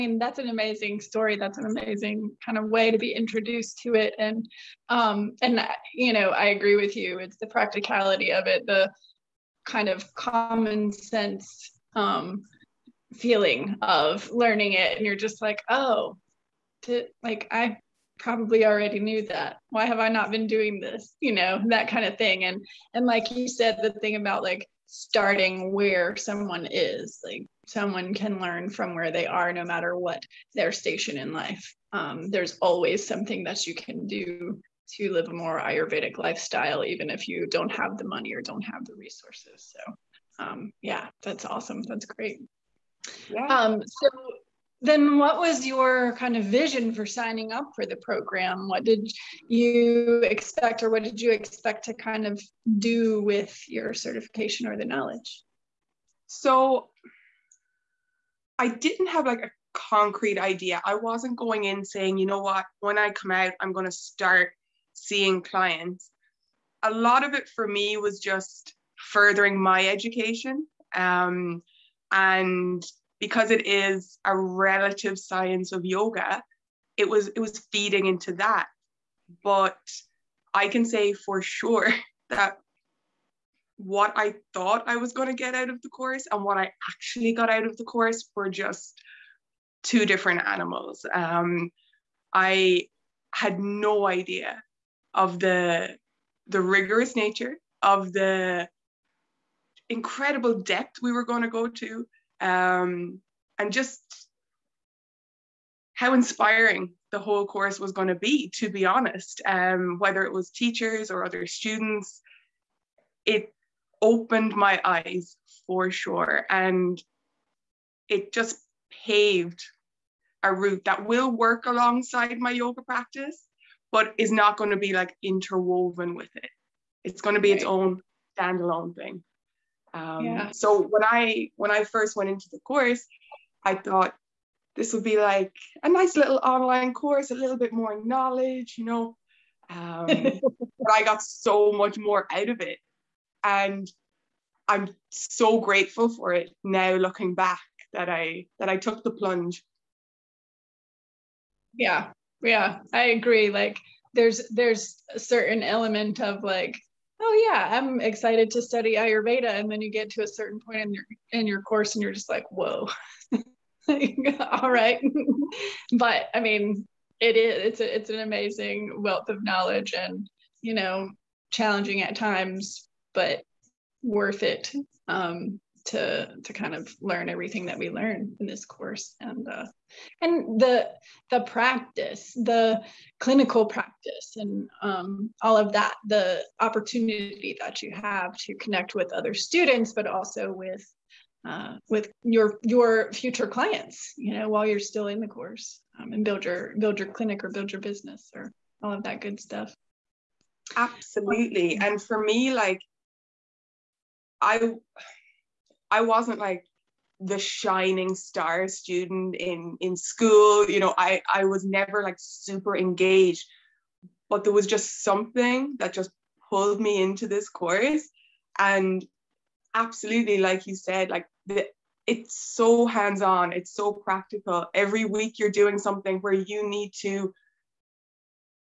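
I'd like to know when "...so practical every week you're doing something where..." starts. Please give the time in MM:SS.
03:43.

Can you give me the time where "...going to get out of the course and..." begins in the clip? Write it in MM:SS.
01:25.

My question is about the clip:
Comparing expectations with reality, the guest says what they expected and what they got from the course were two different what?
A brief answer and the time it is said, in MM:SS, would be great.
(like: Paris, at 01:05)
animals, at 01:30.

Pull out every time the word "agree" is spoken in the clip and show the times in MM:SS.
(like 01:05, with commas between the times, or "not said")
00:06, 02:33.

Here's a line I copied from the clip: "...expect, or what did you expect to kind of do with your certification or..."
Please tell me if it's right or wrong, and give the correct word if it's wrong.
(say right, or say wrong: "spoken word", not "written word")
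right.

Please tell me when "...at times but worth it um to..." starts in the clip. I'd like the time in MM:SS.
02:52.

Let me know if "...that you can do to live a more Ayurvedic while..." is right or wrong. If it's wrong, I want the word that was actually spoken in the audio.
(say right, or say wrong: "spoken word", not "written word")
wrong: "lifestyle", not "while".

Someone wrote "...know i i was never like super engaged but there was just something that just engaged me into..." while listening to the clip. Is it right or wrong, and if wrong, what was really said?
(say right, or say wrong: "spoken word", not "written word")
wrong: "pulled", not "engaged".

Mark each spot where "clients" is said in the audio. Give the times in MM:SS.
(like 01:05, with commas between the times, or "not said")
01:05, 03:13.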